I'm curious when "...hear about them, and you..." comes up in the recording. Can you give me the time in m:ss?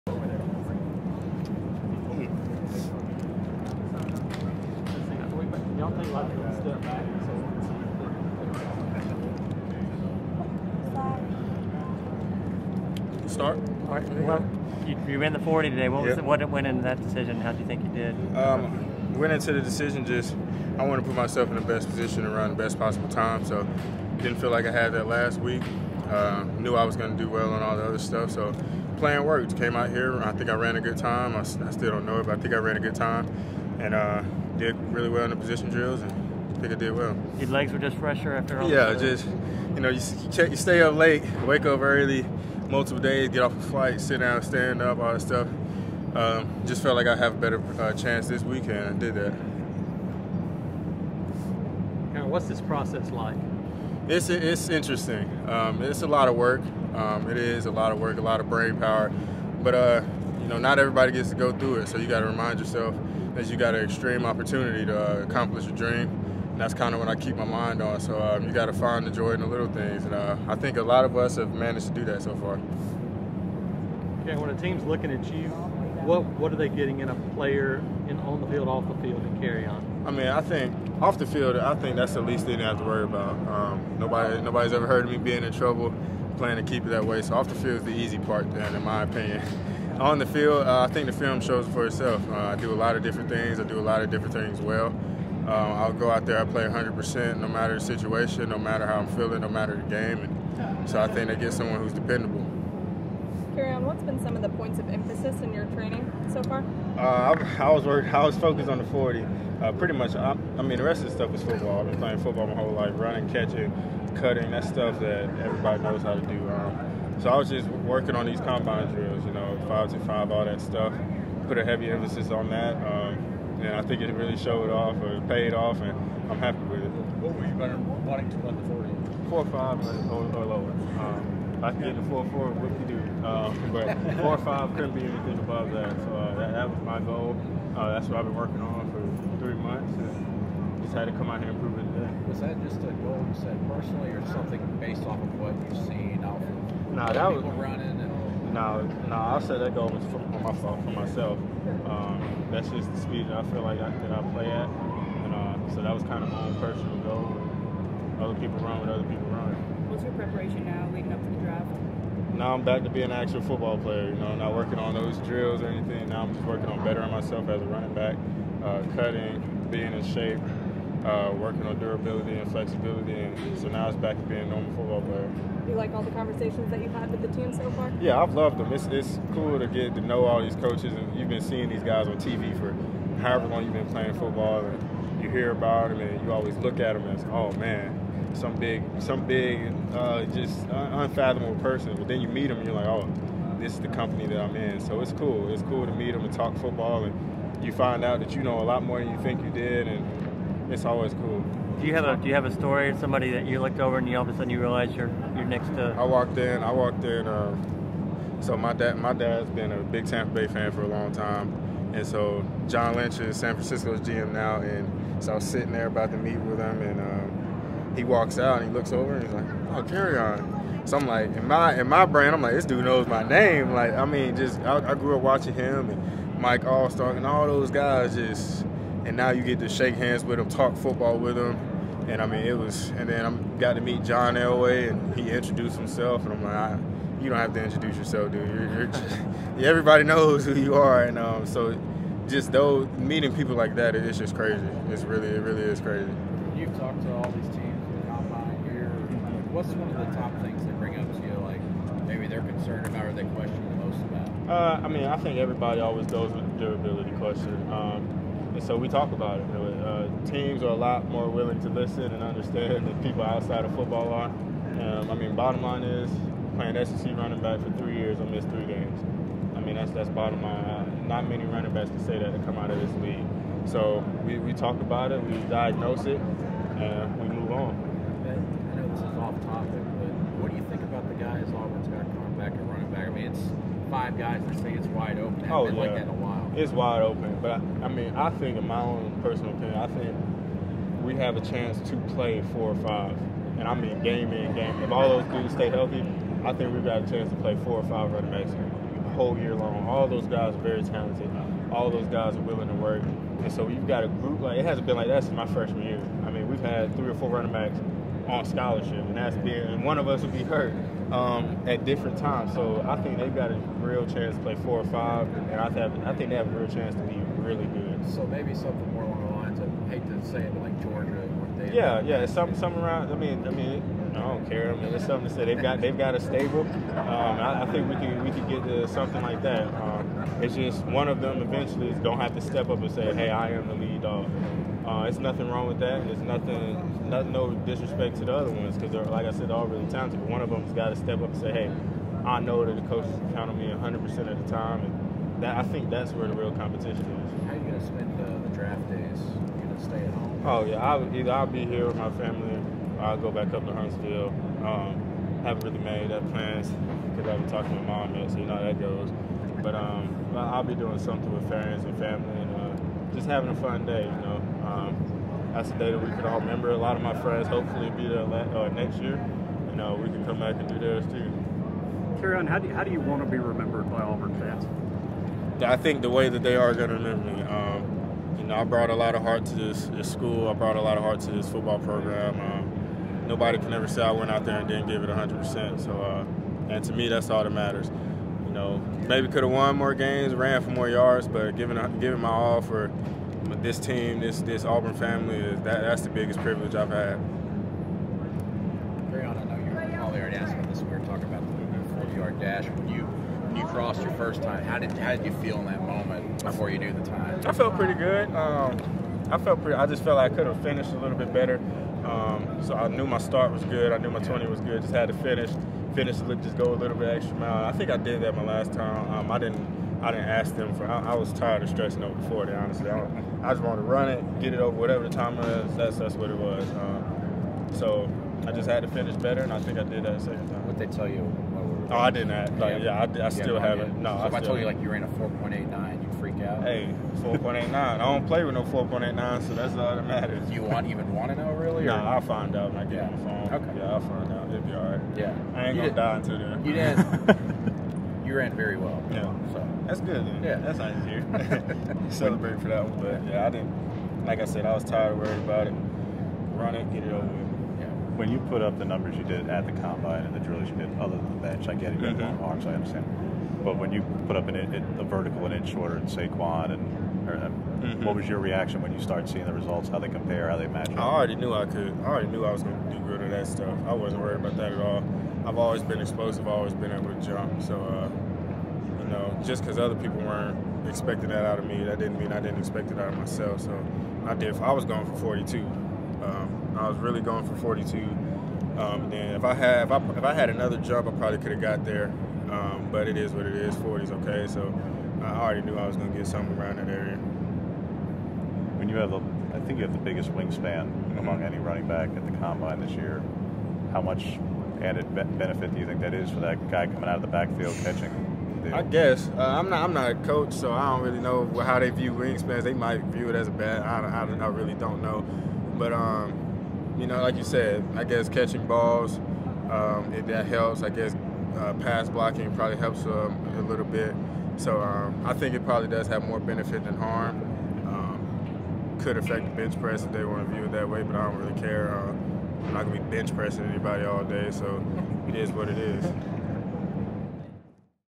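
3:05.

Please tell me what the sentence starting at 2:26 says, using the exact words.
Nah, that was running and now, now I set that goal for, for myself.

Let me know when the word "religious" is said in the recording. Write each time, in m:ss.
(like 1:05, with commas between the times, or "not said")
not said.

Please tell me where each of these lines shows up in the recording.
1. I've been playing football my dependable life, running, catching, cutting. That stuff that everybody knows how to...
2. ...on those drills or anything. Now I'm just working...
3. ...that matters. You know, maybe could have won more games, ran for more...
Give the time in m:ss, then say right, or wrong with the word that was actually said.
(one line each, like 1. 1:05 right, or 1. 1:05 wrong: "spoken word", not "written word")
1. 1:51 wrong: "whole", not "dependable"
2. 2:44 right
3. 6:27 right.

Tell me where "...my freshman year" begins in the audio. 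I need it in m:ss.
5:05.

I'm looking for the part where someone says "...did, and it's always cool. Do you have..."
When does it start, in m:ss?
3:19.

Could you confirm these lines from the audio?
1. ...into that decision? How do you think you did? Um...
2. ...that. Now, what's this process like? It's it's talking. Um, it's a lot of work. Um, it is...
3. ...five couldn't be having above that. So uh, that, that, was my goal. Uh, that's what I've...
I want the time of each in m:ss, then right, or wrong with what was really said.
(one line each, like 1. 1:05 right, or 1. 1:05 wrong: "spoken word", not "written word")
1. 0:16 right
2. 0:49 wrong: "interesting", not "talking"
3. 2:14 wrong: "anything", not "having".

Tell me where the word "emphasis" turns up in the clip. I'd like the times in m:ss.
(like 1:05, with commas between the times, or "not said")
1:44, 2:01.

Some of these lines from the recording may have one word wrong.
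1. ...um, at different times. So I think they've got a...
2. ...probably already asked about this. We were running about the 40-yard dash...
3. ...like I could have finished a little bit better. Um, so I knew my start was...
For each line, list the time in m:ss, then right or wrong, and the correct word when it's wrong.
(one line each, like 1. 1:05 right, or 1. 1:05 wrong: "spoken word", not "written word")
1. 5:11 right
2. 6:39 wrong: "talking", not "running"
3. 6:50 right.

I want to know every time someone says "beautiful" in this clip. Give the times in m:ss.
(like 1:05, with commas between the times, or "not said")
not said.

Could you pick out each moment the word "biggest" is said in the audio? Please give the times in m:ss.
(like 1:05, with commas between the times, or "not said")
6:36, 8:19.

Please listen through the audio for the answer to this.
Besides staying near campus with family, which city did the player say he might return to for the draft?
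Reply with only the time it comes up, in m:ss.
5:53.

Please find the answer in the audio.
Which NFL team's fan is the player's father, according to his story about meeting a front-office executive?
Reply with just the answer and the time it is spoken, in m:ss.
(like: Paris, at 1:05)
Tampa Bay, at 3:30.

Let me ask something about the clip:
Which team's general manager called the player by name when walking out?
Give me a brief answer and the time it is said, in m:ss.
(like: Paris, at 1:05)
San Francisco, at 3:33.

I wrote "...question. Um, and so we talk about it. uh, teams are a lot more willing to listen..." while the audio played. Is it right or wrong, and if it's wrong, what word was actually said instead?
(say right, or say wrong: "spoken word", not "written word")
right.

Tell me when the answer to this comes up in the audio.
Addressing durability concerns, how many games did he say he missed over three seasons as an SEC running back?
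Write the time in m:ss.
4:28.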